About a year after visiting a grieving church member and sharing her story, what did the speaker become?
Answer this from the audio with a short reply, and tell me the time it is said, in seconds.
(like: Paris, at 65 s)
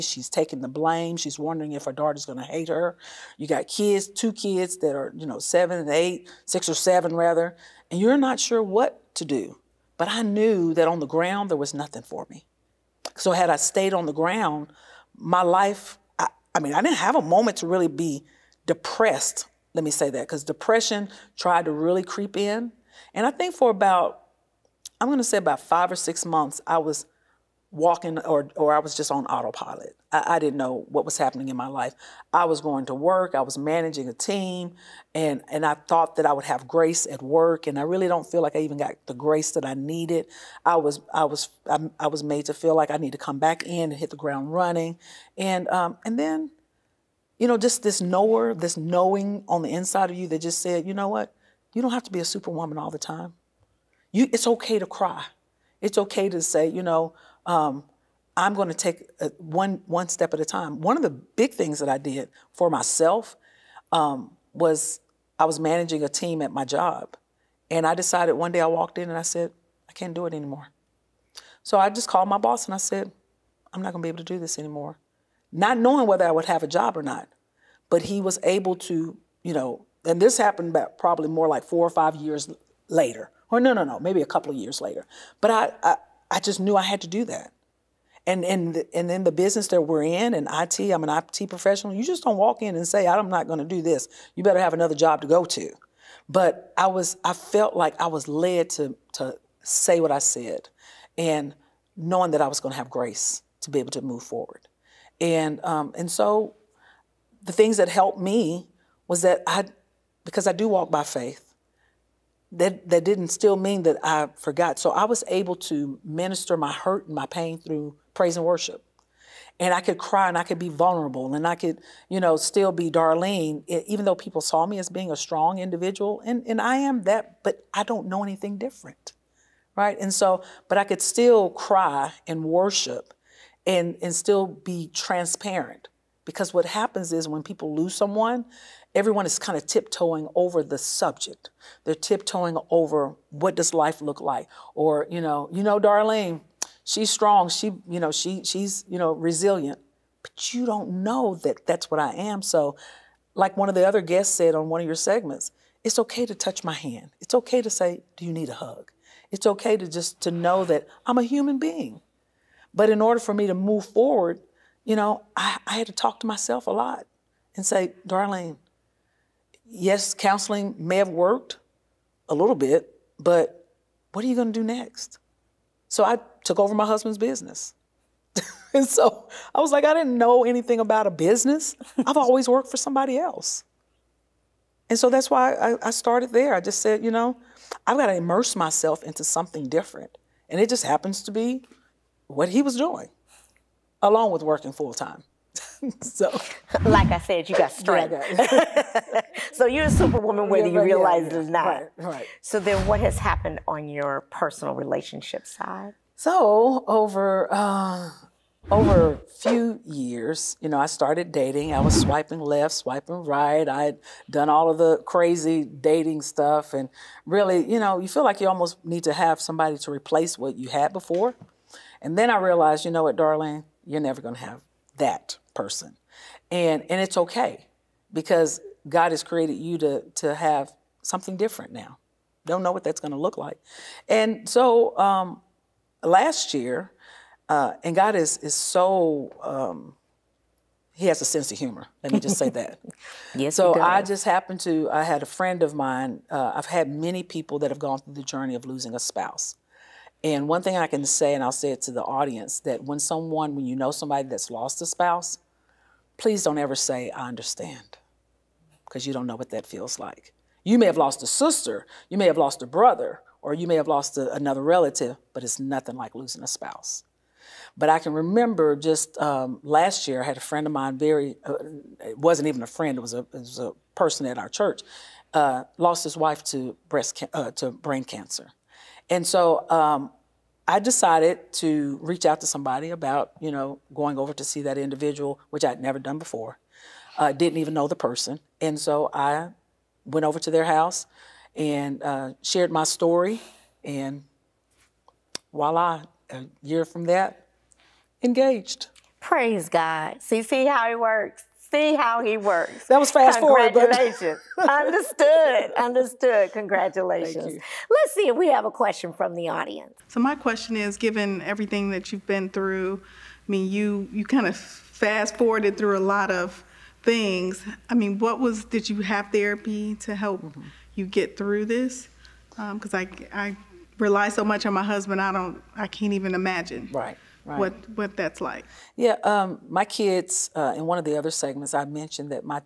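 Engaged, at 298 s.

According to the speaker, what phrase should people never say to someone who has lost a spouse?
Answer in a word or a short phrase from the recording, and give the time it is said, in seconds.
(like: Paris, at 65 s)
I understand, at 257 s.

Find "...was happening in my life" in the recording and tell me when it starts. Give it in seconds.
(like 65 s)
31 s.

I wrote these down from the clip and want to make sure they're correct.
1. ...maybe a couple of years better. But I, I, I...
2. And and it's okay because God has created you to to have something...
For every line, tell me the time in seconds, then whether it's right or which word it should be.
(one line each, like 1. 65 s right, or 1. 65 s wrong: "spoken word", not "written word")
1. 84 s wrong: "later", not "better"
2. 226 s right.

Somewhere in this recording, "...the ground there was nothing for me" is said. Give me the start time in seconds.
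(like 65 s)
10 s.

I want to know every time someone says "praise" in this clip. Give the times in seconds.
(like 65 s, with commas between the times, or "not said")
118 s, 299 s.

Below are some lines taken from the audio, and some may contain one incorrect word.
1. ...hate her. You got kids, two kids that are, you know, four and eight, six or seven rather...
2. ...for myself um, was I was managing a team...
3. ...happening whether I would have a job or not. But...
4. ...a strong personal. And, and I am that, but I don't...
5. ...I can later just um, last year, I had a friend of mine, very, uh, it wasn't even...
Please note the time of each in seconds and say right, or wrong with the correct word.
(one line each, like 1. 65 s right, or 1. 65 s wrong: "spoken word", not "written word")
1. 2 s wrong: "seven", not "four"
2. 62 s right
3. 75 s wrong: "knowing", not "happening"
4. 125 s wrong: "individual", not "personal"
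5. 267 s wrong: "remember", not "later".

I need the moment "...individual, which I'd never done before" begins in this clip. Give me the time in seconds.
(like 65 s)
284 s.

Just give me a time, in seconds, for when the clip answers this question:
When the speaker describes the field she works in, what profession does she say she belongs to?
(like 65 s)
91 s.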